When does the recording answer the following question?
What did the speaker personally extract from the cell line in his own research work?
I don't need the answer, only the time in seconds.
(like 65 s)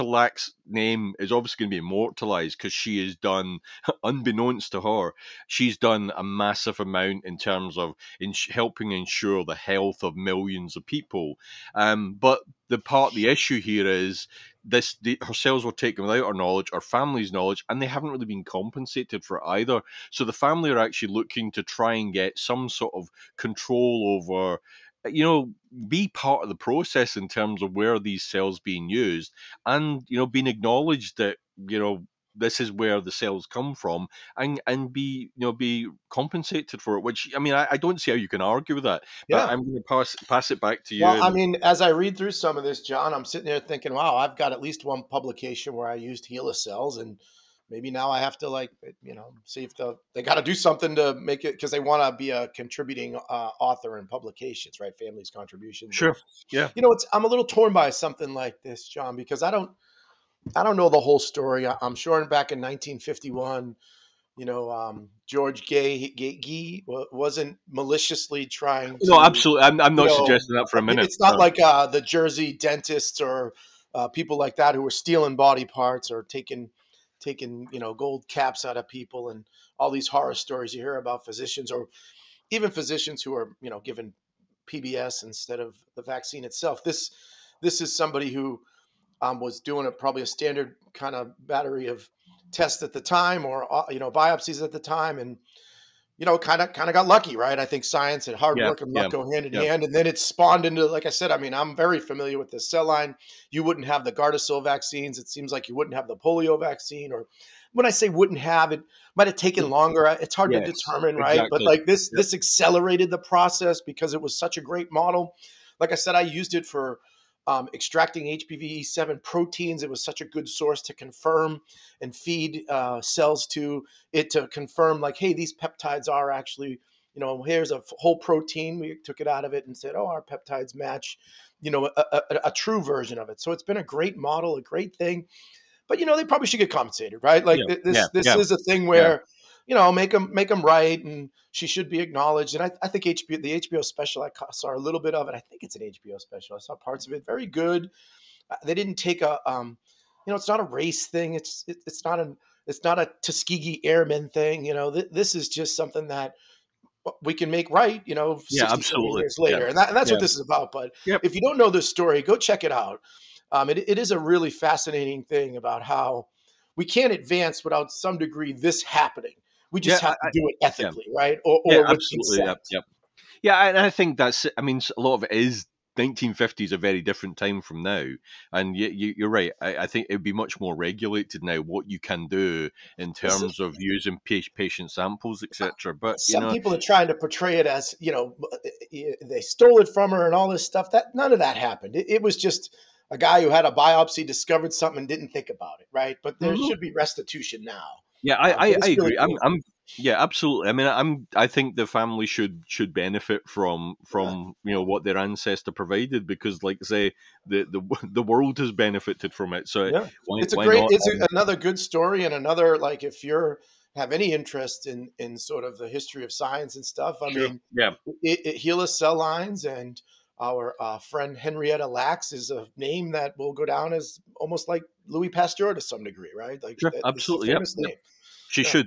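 118 s.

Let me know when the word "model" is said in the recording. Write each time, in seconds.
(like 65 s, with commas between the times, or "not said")
114 s, 134 s.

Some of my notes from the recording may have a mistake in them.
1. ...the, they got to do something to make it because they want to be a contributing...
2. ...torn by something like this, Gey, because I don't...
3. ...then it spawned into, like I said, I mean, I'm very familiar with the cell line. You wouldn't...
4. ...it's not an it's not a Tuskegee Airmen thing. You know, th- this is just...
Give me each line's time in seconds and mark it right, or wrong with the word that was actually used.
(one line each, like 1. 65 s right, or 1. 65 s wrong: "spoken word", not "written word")
1. 49 s right
2. 57 s wrong: "John", not "Gey"
3. 99 s right
4. 151 s right.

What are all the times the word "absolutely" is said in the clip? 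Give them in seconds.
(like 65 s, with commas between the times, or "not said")
69 s, 158 s, 171 s, 200 s, 227 s.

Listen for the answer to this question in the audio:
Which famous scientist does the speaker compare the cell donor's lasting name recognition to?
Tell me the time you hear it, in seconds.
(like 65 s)
225 s.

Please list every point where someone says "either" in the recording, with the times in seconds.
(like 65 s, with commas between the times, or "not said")
19 s.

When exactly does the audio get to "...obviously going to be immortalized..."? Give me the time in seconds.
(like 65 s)
1 s.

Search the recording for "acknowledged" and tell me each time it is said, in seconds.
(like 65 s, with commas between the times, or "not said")
30 s, 142 s.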